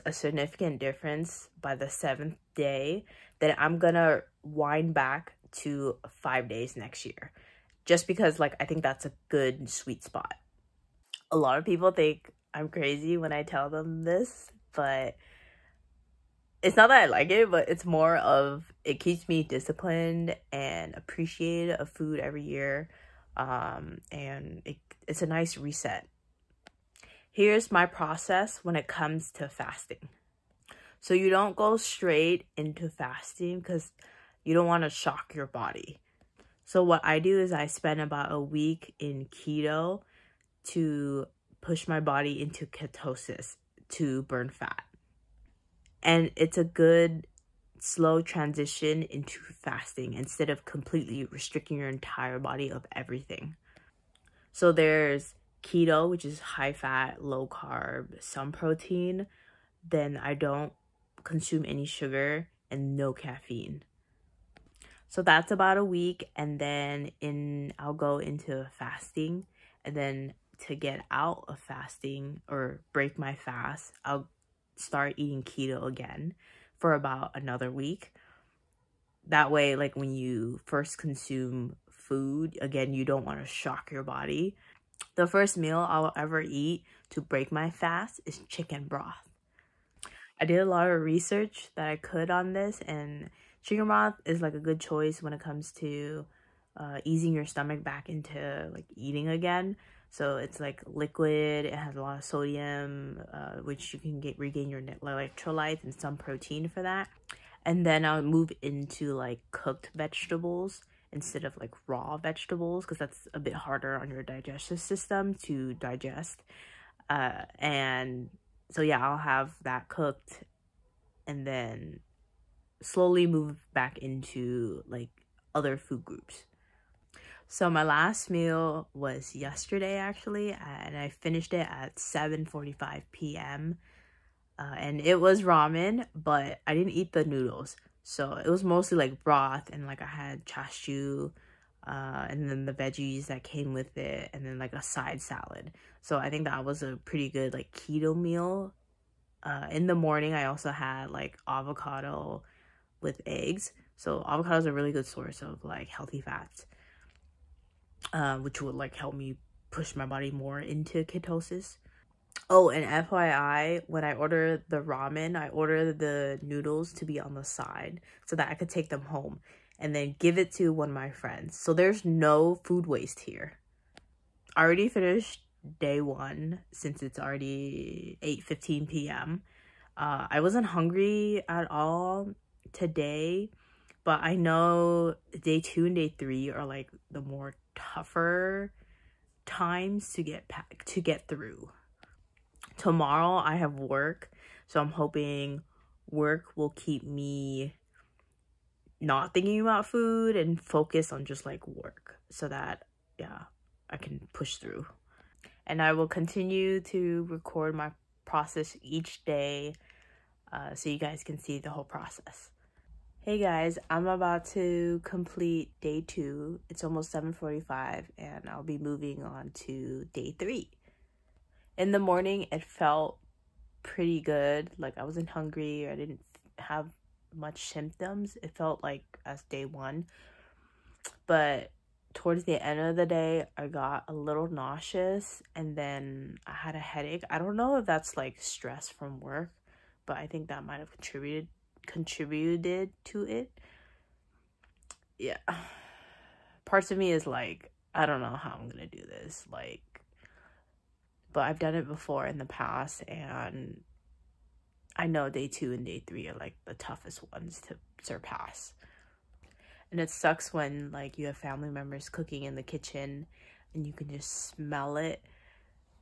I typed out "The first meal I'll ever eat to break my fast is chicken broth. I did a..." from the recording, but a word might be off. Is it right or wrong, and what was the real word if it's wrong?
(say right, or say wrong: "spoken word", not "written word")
right.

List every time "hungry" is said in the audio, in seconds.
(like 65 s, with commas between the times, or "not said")
180 s, 225 s.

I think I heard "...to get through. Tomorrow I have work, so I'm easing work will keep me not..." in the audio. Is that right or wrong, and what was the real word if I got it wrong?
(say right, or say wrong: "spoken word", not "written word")
wrong: "hoping", not "easing".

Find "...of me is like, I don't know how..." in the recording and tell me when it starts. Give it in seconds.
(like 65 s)
246 s.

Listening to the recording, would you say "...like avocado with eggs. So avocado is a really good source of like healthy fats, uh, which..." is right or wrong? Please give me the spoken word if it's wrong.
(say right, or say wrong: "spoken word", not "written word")
right.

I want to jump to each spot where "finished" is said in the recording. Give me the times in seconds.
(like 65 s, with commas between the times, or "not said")
131 s, 174 s.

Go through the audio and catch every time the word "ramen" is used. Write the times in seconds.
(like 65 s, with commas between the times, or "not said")
135 s, 164 s.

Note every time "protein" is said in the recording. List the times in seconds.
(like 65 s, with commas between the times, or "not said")
58 s, 106 s.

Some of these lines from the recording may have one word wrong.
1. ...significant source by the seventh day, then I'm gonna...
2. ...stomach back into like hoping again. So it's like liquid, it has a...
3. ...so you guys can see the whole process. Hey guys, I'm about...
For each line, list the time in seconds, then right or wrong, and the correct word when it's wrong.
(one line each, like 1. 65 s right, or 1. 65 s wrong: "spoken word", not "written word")
1. 0 s wrong: "difference", not "source"
2. 97 s wrong: "eating", not "hoping"
3. 210 s right.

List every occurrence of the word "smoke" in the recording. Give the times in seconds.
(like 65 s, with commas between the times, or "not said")
not said.